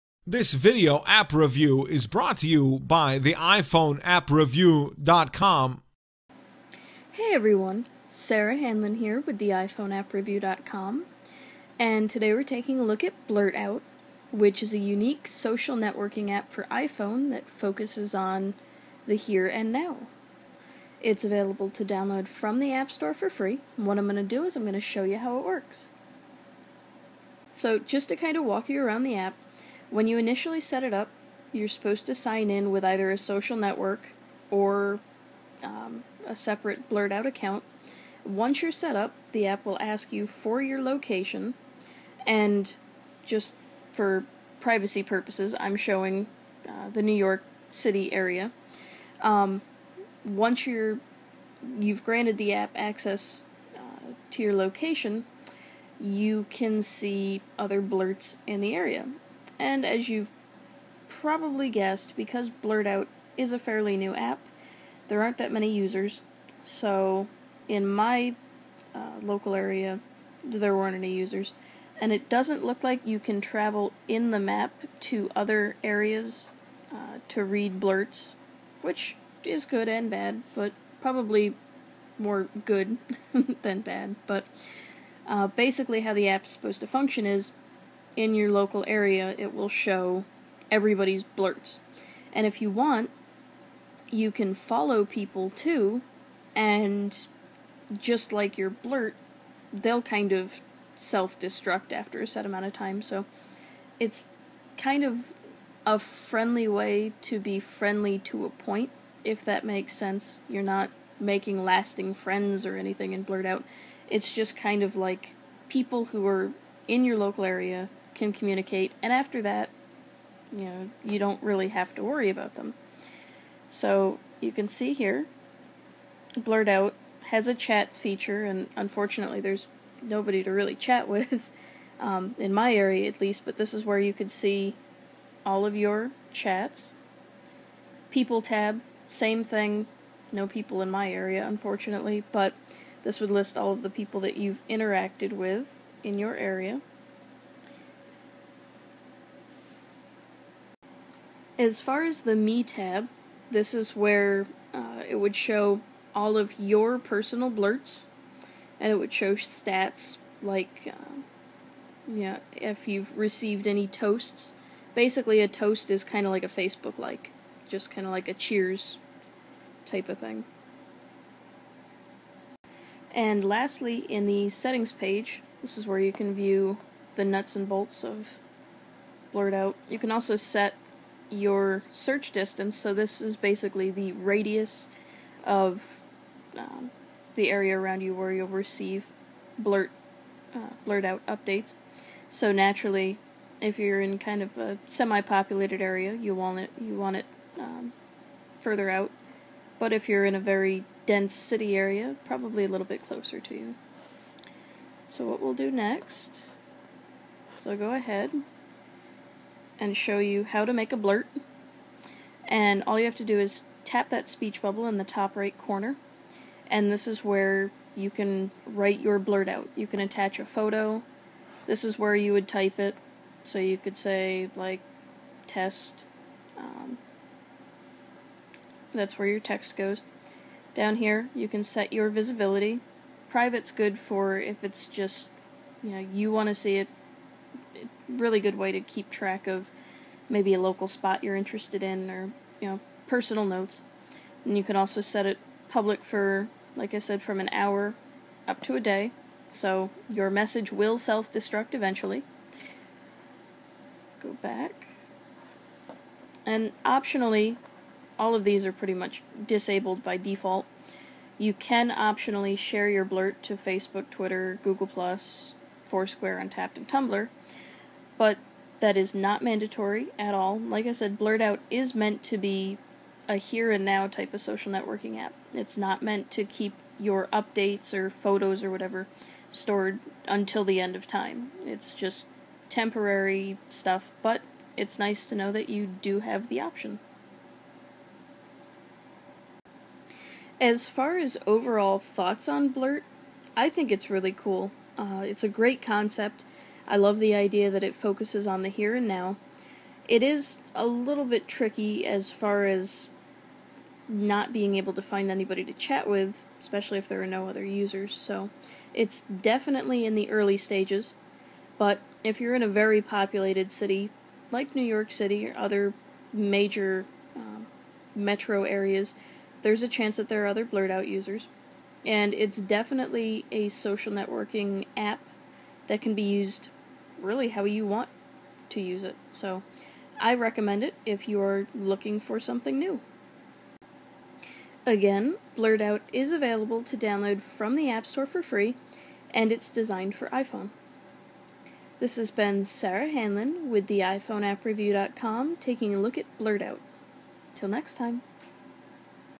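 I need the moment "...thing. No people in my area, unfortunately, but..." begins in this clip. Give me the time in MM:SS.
02:19.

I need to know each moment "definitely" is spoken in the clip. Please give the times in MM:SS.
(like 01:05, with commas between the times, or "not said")
05:09, 05:22.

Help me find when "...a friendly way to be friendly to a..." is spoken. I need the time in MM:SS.
01:45.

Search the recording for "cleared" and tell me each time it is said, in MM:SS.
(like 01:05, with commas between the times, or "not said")
not said.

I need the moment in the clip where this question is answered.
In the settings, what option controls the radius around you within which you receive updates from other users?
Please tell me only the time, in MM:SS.
03:01.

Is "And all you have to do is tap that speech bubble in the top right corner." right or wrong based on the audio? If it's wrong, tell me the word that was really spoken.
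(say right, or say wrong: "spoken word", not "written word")
right.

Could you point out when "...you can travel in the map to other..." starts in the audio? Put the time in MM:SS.
01:13.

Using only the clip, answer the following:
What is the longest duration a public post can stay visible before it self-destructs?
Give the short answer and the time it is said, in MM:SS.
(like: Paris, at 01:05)
a day, at 04:08.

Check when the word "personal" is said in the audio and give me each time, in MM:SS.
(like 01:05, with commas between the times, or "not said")
02:36, 04:03.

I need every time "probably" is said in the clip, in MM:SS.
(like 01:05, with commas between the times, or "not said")
01:01, 01:21, 03:22.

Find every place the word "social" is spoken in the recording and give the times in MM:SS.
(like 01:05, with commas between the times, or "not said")
00:15, 00:33, 04:34, 05:23.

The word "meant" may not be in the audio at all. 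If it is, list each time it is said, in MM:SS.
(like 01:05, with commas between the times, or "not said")
04:31, 04:36.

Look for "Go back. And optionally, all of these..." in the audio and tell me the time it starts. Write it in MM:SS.
04:14.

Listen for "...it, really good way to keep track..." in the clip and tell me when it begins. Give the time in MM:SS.
03:56.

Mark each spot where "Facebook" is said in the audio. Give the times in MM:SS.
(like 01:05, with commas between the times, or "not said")
02:46, 04:23.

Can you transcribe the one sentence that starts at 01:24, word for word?
But uh, basically, how the app is supposed to function is in your local area, it will show everybody's blurts.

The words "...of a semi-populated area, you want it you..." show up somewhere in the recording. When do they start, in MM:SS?
03:14.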